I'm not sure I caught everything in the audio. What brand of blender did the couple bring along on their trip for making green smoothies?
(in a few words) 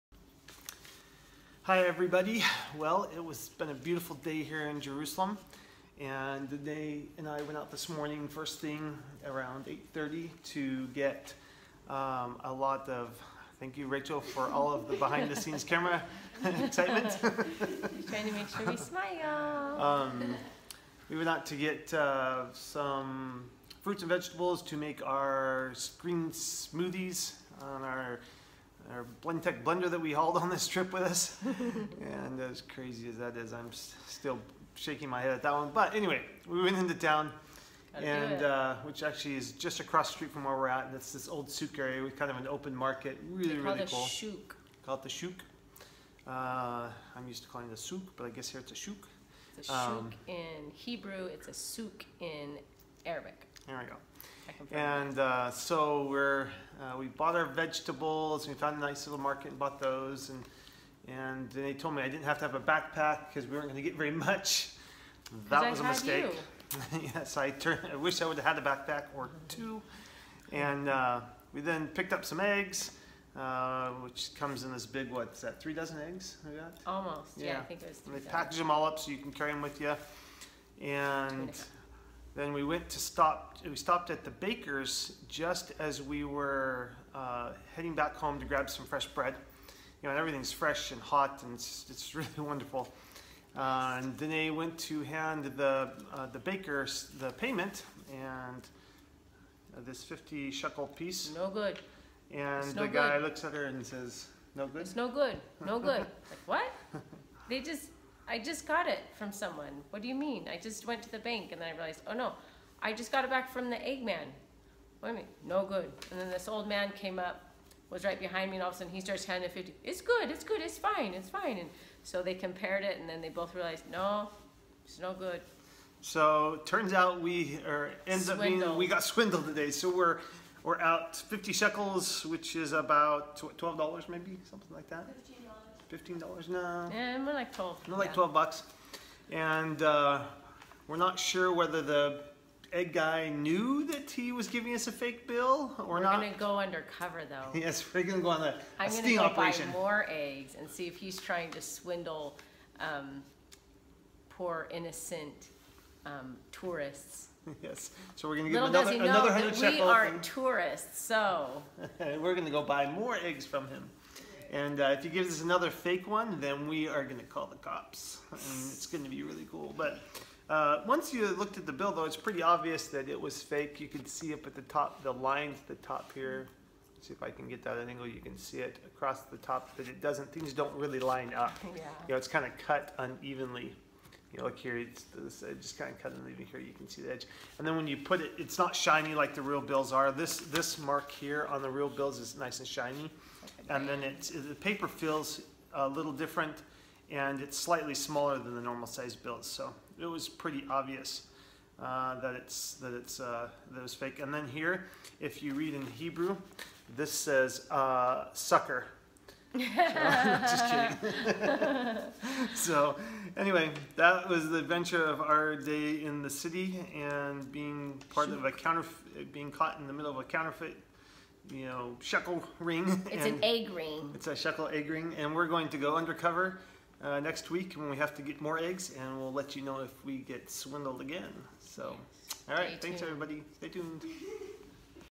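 Blendtec.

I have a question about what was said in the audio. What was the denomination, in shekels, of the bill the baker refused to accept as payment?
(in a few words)
50.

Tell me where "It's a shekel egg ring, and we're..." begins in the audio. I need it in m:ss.
3:44.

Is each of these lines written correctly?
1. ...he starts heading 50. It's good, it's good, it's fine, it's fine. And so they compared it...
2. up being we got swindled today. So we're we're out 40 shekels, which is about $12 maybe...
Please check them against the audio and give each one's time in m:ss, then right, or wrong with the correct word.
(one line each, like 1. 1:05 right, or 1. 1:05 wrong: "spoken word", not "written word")
1. 1:58 wrong: "handing", not "heading"
2. 2:08 wrong: "50", not "40".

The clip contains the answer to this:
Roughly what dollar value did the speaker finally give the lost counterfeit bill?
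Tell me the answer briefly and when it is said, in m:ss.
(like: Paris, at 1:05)
$12, at 2:18.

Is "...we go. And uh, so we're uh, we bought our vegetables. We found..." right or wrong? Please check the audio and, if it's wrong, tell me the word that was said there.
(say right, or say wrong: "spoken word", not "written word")
right.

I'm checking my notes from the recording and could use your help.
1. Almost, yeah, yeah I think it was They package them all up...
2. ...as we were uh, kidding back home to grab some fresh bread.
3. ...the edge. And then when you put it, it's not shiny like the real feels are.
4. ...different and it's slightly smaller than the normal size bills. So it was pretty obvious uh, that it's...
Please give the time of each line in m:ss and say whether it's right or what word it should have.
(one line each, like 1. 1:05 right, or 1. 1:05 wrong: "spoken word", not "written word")
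1. 1:16 right
2. 1:25 wrong: "heading", not "kidding"
3. 3:07 wrong: "bills", not "feels"
4. 3:16 right.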